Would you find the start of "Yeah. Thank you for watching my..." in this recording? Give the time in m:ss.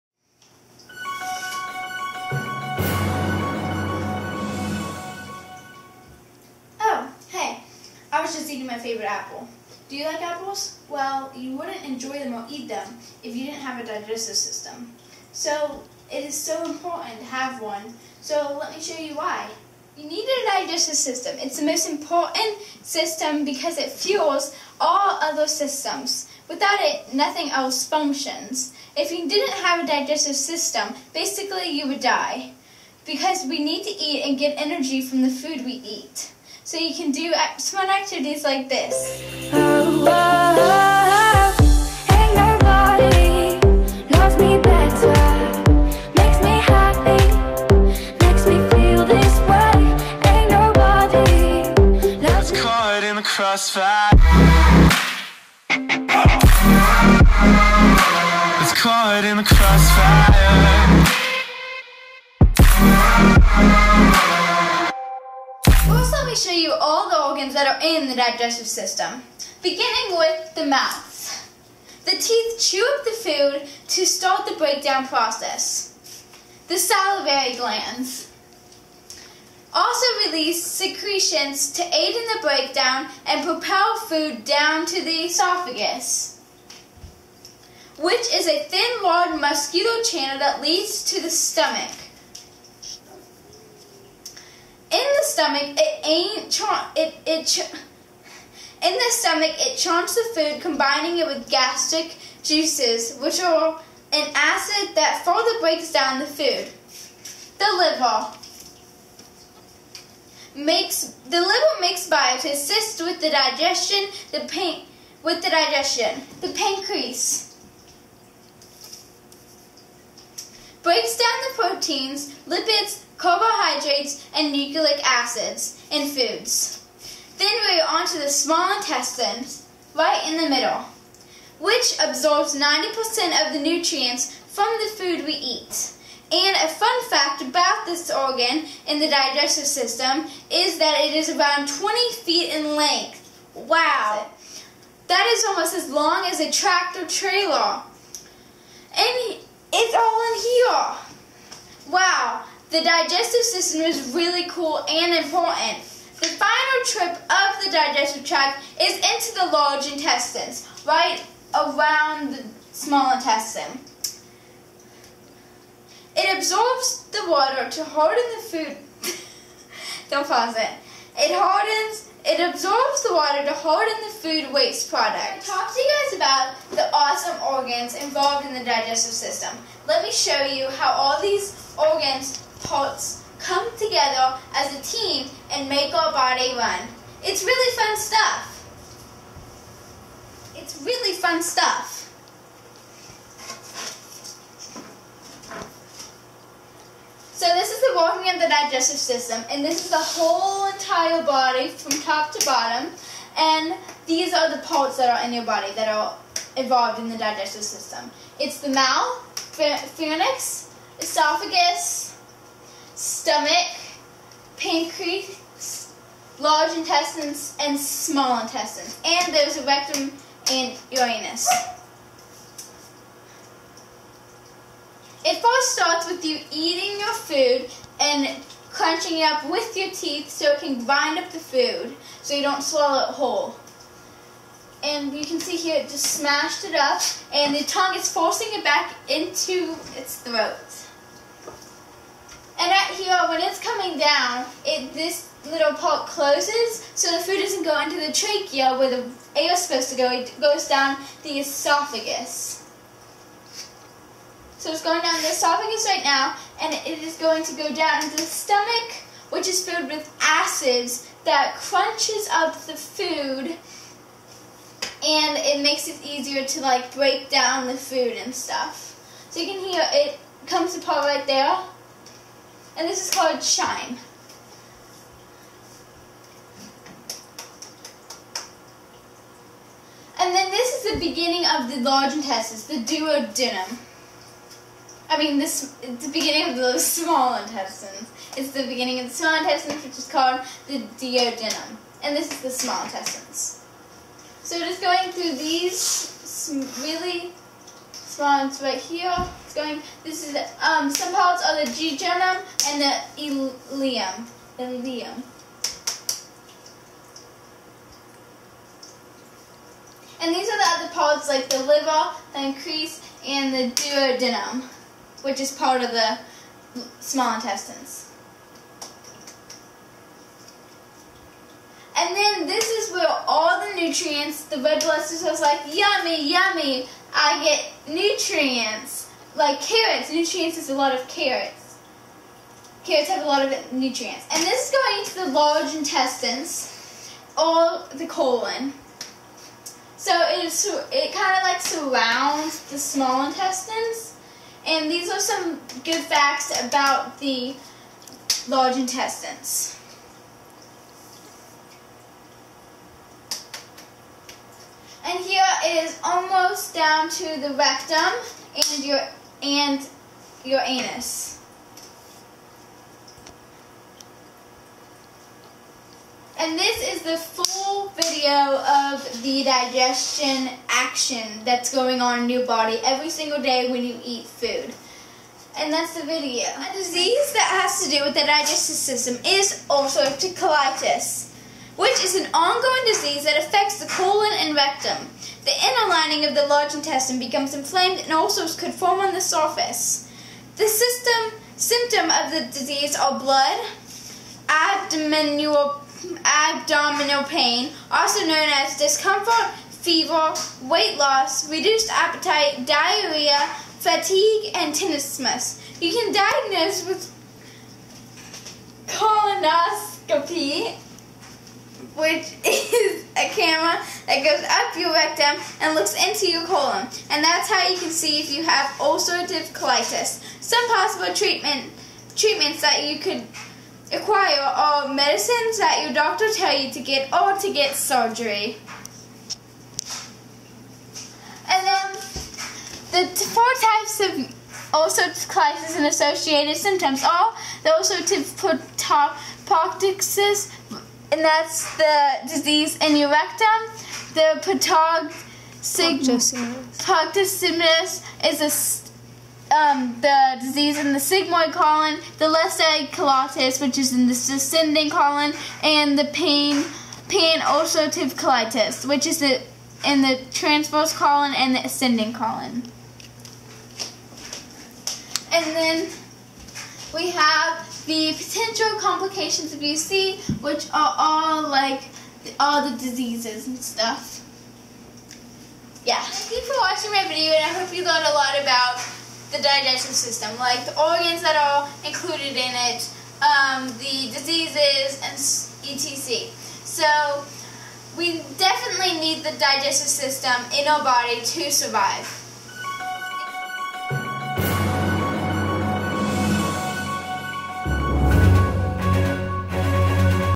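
7:55.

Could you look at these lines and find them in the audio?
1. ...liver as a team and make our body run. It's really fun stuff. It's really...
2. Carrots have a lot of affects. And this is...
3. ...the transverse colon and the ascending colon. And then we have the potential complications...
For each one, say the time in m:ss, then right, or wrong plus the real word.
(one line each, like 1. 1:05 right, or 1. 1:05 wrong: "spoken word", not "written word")
1. 3:03 wrong: "together", not "liver"
2. 5:32 wrong: "nutrients", not "affects"
3. 7:40 right.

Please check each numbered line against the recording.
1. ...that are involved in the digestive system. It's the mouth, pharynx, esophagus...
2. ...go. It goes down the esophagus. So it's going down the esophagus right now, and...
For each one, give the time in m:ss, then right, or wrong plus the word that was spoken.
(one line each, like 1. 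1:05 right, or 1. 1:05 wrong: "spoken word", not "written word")
1. 3:25 right
2. 4:09 right.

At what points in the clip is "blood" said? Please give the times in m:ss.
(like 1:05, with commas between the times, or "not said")
5:24, 6:33.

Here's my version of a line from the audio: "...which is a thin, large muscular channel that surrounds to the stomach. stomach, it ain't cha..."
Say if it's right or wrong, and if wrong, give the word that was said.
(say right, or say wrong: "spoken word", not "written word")
wrong: "leads", not "surrounds".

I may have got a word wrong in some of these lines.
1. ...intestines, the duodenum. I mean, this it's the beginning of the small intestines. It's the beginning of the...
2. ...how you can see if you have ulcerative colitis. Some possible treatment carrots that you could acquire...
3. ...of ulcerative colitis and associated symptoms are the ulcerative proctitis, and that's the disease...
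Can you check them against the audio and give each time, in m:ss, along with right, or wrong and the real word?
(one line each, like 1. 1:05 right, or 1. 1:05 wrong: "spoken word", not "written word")
1. 4:42 right
2. 6:57 wrong: "treatments", not "carrots"
3. 7:13 right.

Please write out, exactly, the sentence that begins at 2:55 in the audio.
I'm talk to you guys about the awesome organs involved in the digestive system.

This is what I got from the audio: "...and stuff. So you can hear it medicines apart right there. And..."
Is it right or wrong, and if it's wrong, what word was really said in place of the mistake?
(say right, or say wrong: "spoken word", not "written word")
wrong: "comes", not "medicines".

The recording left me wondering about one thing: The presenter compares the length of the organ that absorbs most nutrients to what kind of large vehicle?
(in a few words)
tractor trailer.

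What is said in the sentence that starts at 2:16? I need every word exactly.
And a fun fact about this organ in the digestive system is that it is about 20 feet in length.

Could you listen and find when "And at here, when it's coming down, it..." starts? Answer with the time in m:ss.
4:02.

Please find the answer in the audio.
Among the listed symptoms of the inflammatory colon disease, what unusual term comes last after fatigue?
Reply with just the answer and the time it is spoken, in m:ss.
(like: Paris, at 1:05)
tenesmus, at 6:44.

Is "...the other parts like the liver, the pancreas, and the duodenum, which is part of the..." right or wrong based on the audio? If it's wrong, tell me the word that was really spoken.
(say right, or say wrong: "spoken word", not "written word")
right.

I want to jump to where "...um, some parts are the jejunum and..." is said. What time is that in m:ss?
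5:00.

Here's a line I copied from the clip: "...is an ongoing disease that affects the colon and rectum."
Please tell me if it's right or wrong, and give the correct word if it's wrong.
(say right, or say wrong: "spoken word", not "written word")
right.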